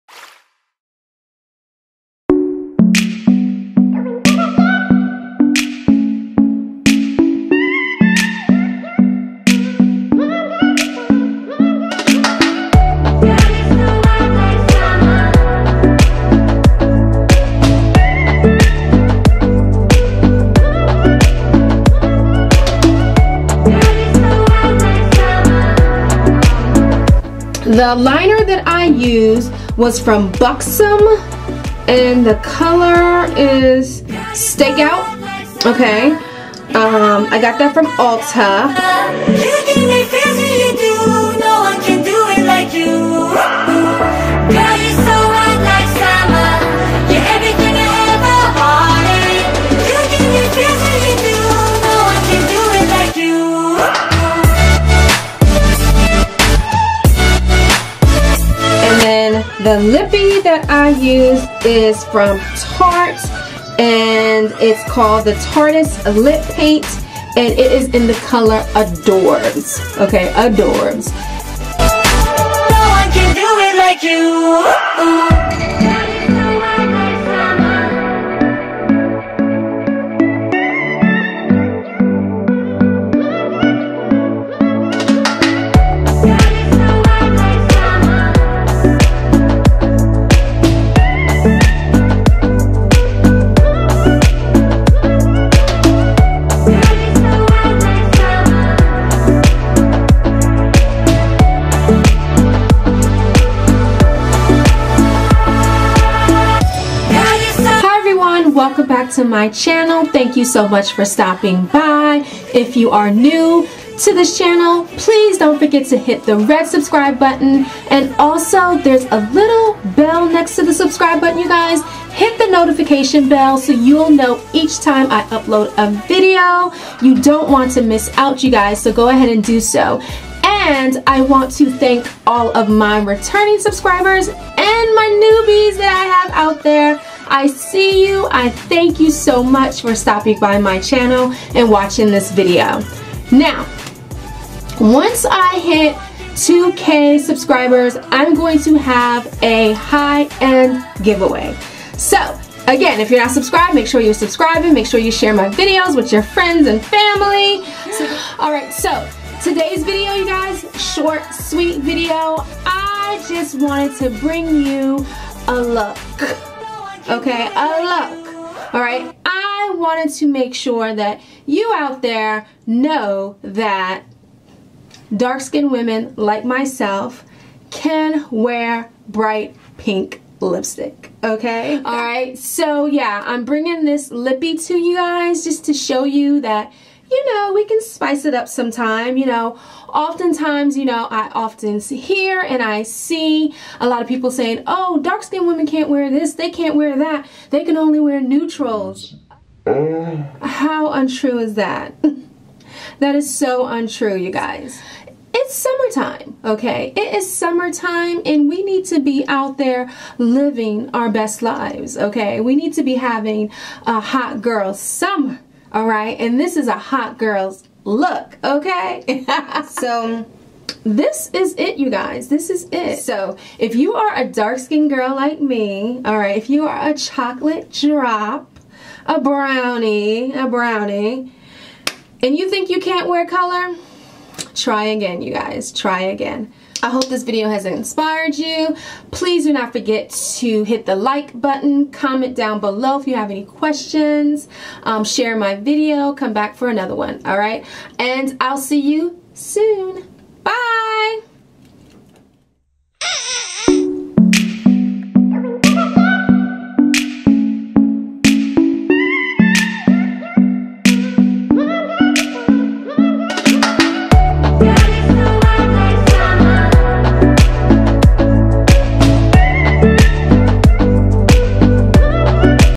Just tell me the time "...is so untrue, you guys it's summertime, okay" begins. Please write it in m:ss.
3:23.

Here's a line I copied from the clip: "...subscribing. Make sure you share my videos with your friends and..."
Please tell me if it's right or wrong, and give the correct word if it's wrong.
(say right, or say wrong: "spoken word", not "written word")
right.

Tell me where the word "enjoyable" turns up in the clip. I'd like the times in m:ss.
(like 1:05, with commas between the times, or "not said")
not said.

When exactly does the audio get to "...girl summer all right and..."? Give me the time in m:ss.
3:34.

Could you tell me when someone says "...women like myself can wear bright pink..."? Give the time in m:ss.
2:55.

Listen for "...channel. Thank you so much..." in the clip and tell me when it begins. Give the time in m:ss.
1:49.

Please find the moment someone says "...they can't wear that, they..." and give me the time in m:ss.
3:16.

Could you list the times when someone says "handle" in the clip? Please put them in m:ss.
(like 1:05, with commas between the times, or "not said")
not said.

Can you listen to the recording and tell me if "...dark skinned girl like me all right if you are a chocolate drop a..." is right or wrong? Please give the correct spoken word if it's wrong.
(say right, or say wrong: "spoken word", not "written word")
right.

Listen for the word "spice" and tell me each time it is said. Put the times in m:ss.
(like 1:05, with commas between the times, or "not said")
3:07.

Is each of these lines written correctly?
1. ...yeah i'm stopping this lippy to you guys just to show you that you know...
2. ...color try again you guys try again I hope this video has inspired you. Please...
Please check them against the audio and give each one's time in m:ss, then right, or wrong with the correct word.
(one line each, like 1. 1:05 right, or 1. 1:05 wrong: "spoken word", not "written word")
1. 3:02 wrong: "bringing", not "stopping"
2. 3:53 right.